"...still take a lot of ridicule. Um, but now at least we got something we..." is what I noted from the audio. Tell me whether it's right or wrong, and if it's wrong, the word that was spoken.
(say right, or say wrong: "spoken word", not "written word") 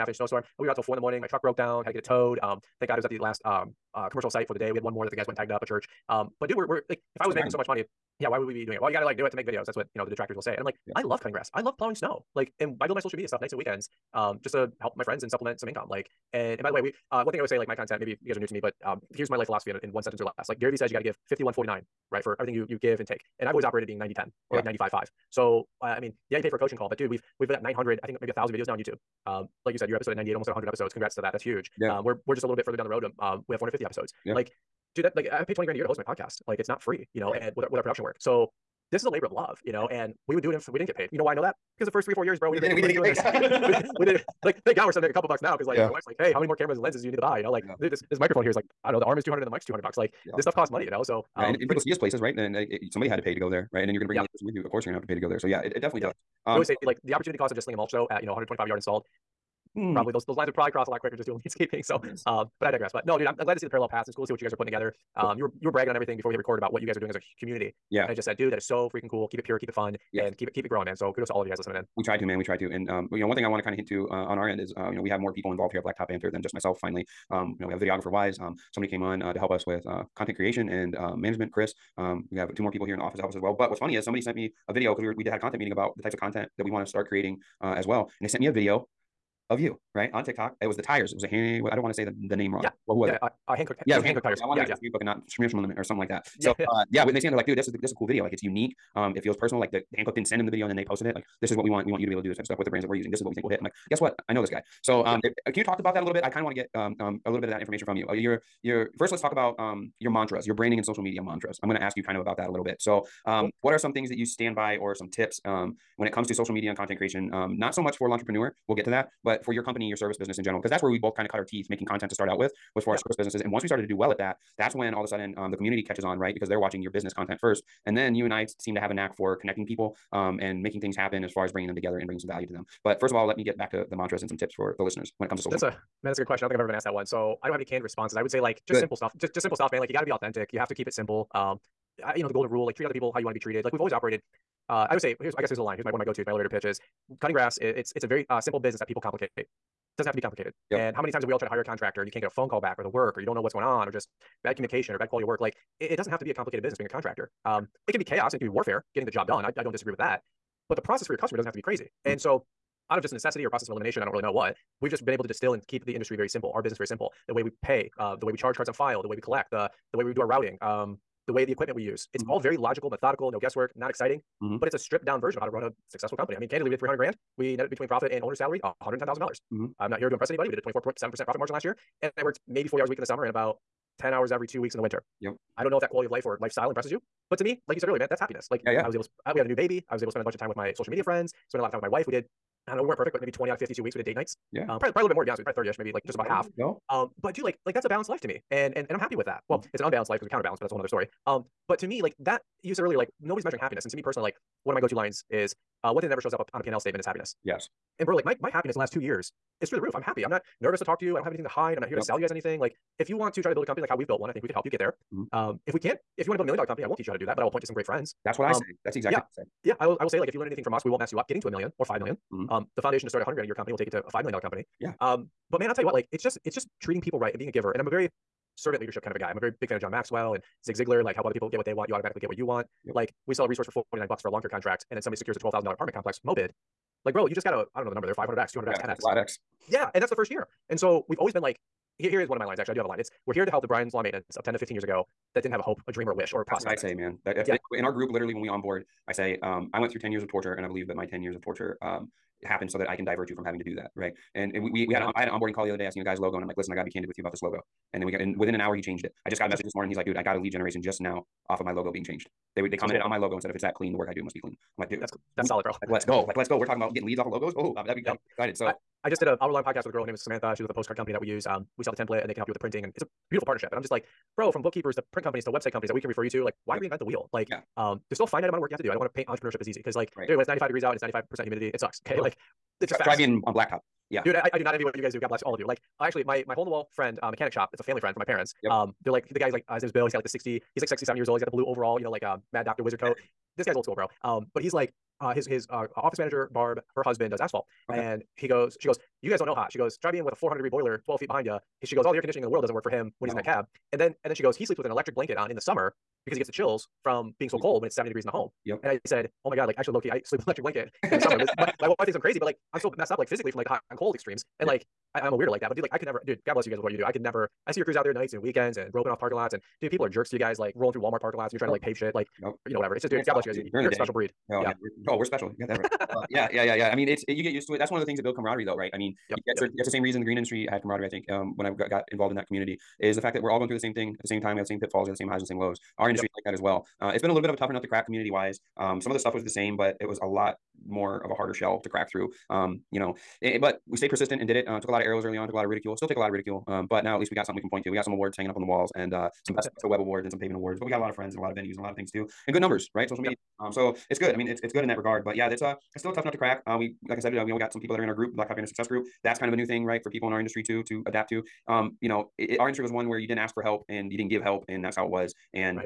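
right.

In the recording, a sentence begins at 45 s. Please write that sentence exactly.
my wife's like, hey, how many more cameras and lenses do you need to buy?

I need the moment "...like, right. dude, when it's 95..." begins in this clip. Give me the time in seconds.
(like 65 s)
279 s.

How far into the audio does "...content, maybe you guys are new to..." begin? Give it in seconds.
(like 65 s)
17 s.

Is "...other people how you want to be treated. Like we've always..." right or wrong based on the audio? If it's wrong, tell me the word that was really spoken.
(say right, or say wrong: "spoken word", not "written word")
right.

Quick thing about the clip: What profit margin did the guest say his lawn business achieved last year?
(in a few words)
24.7%.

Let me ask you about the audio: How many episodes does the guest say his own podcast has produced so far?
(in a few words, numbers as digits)
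450.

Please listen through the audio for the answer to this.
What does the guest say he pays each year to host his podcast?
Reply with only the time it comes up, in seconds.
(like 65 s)
35 s.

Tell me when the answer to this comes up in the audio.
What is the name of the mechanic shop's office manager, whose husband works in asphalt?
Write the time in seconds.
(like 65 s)
296 s.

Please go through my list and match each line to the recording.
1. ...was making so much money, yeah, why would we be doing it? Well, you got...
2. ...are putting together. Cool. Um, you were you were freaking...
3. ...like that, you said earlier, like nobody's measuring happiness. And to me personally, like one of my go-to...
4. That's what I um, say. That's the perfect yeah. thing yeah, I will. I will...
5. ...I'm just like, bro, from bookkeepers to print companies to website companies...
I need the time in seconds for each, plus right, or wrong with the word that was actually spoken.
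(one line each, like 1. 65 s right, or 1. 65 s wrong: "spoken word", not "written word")
1. 7 s right
2. 64 s wrong: "bragging", not "freaking"
3. 202 s right
4. 218 s wrong: "exact", not "perfect"
5. 273 s right.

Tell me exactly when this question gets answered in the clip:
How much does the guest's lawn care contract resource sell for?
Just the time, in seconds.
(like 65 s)
233 s.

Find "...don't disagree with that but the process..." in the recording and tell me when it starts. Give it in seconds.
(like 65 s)
159 s.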